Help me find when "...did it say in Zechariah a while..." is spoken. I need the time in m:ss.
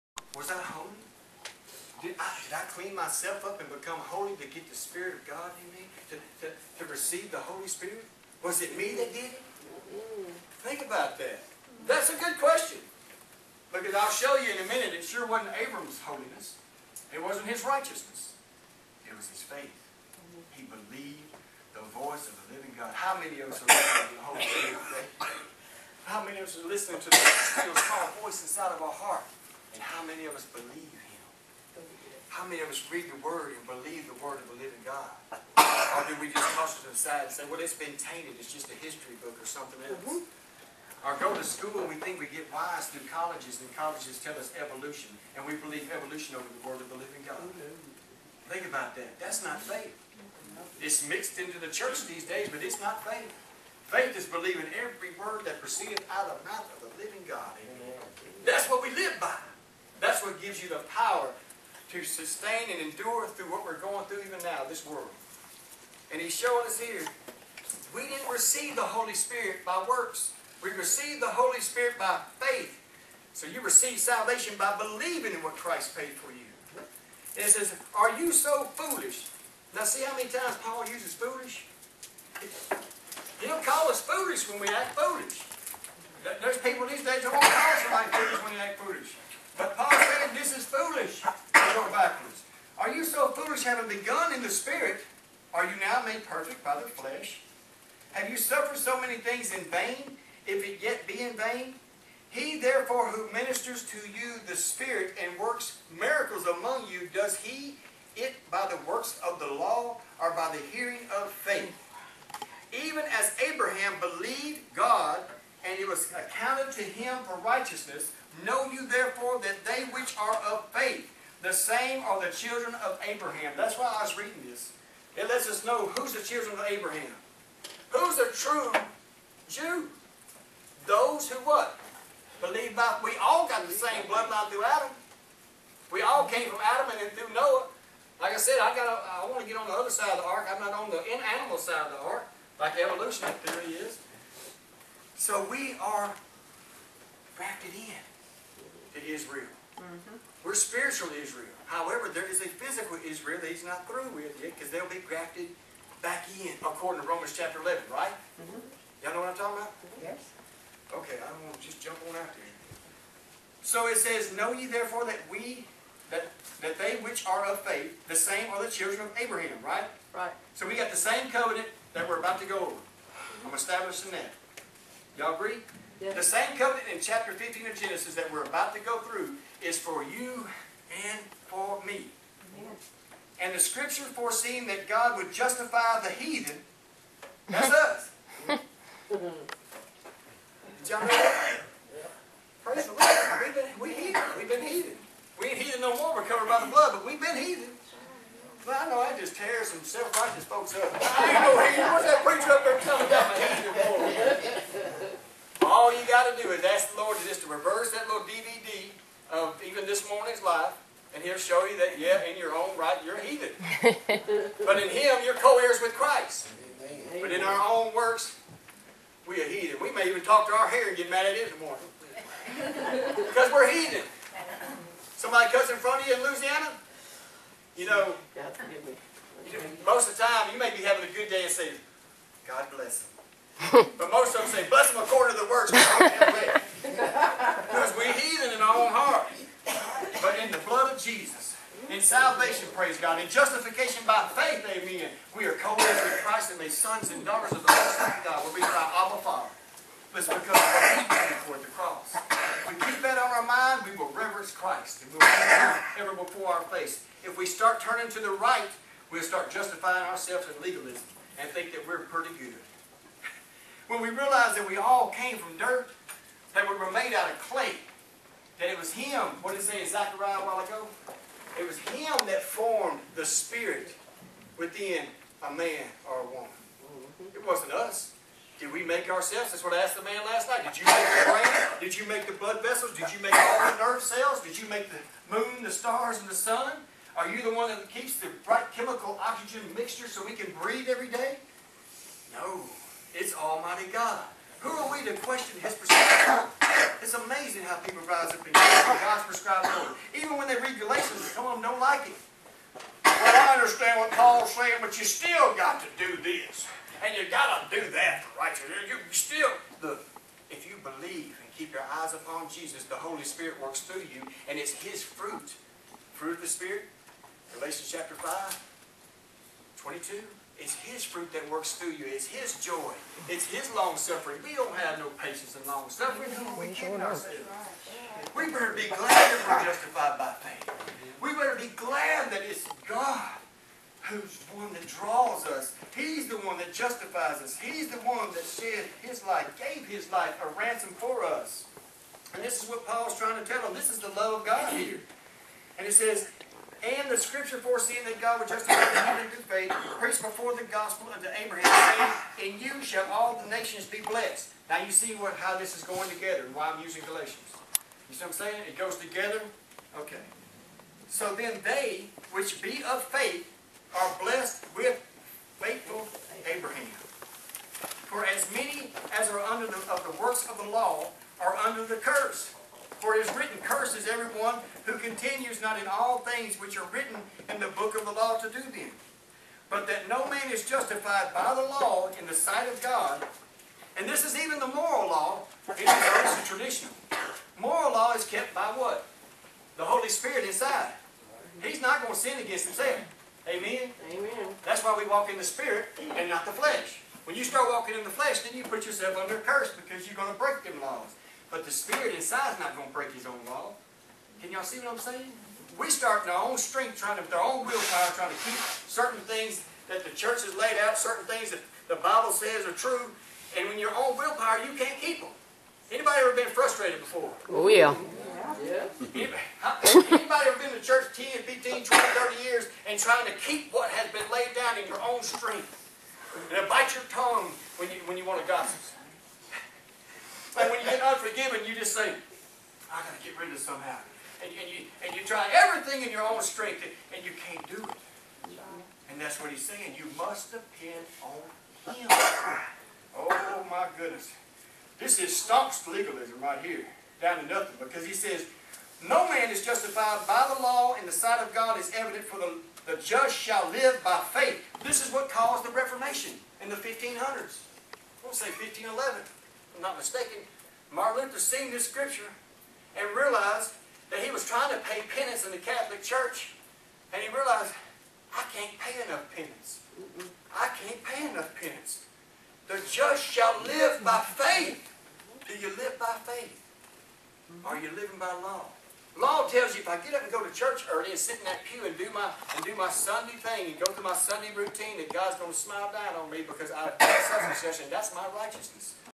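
4:29.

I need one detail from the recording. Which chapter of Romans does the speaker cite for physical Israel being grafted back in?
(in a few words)
Chapter 11.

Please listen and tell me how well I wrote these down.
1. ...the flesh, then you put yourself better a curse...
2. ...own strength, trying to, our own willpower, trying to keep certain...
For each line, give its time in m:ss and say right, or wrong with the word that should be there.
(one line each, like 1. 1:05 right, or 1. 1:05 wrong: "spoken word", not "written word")
1. 6:38 wrong: "under", not "better"
2. 6:46 right.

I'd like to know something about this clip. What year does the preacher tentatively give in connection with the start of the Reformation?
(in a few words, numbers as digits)
1511.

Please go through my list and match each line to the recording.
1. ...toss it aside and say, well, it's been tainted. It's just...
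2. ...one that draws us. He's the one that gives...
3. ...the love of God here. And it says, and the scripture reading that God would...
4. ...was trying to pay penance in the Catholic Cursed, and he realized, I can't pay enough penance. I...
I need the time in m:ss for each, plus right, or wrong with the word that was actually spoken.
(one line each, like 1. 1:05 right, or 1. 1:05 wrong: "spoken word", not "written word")
1. 0:36 right
2. 5:34 wrong: "justifies", not "gives"
3. 5:43 wrong: "foreseeing", not "reading"
4. 7:44 wrong: "Church", not "Cursed".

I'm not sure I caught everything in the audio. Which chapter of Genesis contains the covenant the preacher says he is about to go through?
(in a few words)
Chapter 15.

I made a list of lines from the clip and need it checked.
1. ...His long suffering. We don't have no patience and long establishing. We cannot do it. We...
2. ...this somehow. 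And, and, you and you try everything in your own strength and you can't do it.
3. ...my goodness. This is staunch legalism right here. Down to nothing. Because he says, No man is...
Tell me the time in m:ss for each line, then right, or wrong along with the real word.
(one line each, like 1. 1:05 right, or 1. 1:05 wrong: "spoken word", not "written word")
1. 5:23 wrong: "suffering", not "establishing"
2. 7:13 right
3. 7:23 right.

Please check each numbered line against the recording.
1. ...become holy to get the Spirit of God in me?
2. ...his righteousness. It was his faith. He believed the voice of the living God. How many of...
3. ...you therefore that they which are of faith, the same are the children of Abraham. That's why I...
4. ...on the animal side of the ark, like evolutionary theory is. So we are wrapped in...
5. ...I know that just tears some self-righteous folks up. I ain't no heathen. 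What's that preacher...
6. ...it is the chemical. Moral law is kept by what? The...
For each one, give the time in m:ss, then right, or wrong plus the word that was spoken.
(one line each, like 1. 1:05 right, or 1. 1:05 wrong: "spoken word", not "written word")
1. 0:03 right
2. 0:17 right
3. 1:58 right
4. 2:20 right
5. 3:18 right
6. 6:25 wrong: "traditional", not "chemical".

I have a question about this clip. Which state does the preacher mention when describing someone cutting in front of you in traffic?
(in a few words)
Louisiana.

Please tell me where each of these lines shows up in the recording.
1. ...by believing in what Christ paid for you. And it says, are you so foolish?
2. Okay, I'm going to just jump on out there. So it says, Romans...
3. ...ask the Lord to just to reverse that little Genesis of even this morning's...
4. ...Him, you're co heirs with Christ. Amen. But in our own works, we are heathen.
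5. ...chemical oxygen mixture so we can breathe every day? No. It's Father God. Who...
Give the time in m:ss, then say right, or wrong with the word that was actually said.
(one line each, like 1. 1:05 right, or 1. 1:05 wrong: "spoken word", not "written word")
1. 1:14 right
2. 2:40 wrong: "Know", not "Romans"
3. 3:26 wrong: "DVD", not "Genesis"
4. 3:34 right
5. 4:48 wrong: "Almighty", not "Father".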